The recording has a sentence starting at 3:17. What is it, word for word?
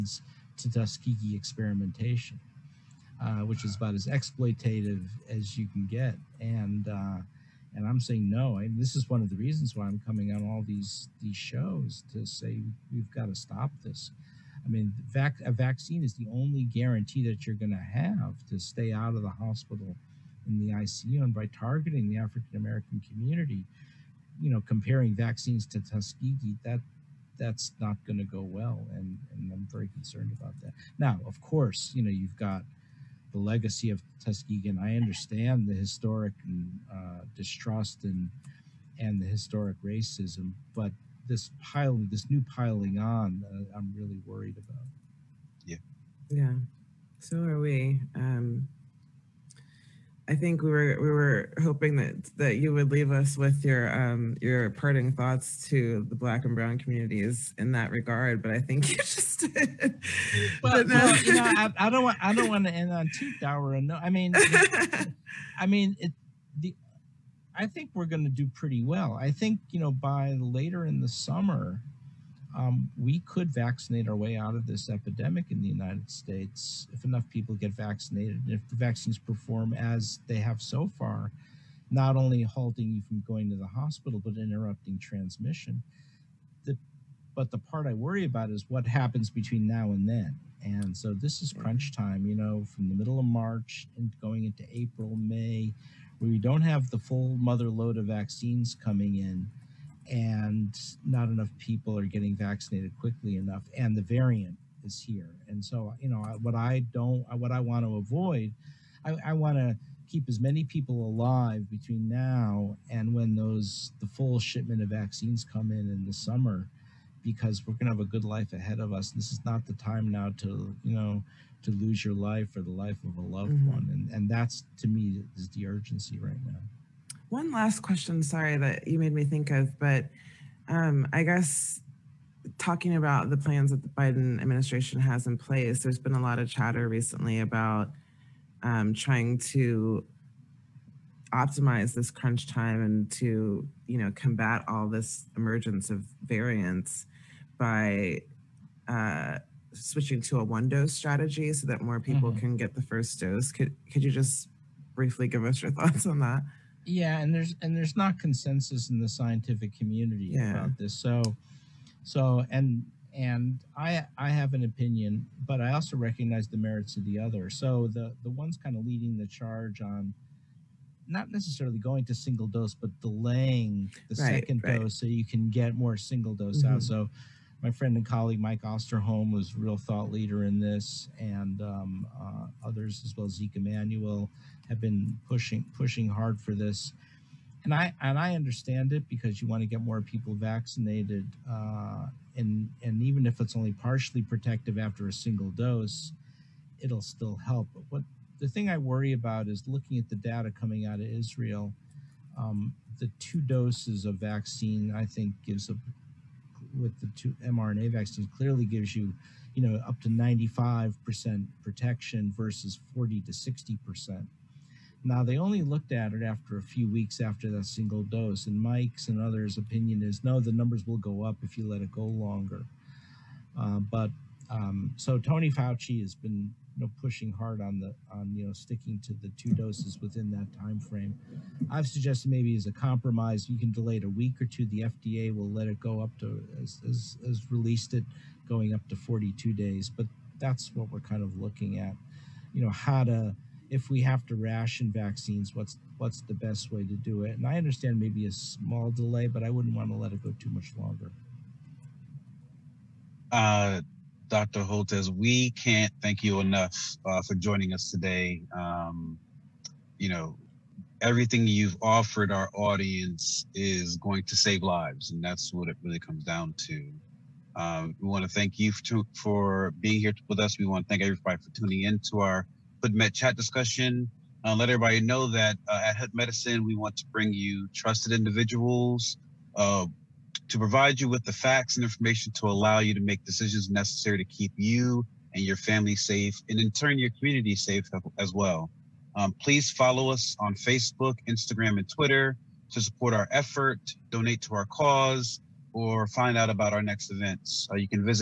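But what the thing I worry about is looking at the data coming out of Israel.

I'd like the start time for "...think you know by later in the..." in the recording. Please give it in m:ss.
1:09.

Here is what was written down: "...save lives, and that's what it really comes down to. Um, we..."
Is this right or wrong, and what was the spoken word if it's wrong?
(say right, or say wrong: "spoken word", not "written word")
right.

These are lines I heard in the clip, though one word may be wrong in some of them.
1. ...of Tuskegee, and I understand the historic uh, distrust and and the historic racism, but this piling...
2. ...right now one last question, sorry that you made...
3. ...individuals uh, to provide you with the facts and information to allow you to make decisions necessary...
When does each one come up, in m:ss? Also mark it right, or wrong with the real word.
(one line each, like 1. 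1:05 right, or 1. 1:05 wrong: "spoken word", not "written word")
1. 0:33 right
2. 2:06 right
3. 4:38 right.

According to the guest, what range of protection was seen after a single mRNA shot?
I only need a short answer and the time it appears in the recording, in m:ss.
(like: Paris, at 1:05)
40 to 60%, at 3:32.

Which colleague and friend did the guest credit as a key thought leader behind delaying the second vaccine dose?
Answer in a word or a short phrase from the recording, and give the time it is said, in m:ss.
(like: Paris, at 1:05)
Mike Osterholm, at 2:58.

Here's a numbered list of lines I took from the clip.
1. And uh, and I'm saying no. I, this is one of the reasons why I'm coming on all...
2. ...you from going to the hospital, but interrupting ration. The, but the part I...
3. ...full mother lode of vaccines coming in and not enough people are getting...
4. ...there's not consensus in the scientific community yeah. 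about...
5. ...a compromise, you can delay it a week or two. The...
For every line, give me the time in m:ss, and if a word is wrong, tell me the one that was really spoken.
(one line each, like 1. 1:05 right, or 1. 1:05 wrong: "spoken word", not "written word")
1. 0:06 right
2. 1:22 wrong: "transmission", not "ration"
3. 1:36 right
4. 2:37 right
5. 3:52 right.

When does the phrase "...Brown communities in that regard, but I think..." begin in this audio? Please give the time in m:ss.
0:56.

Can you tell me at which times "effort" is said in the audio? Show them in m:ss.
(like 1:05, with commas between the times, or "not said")
4:53.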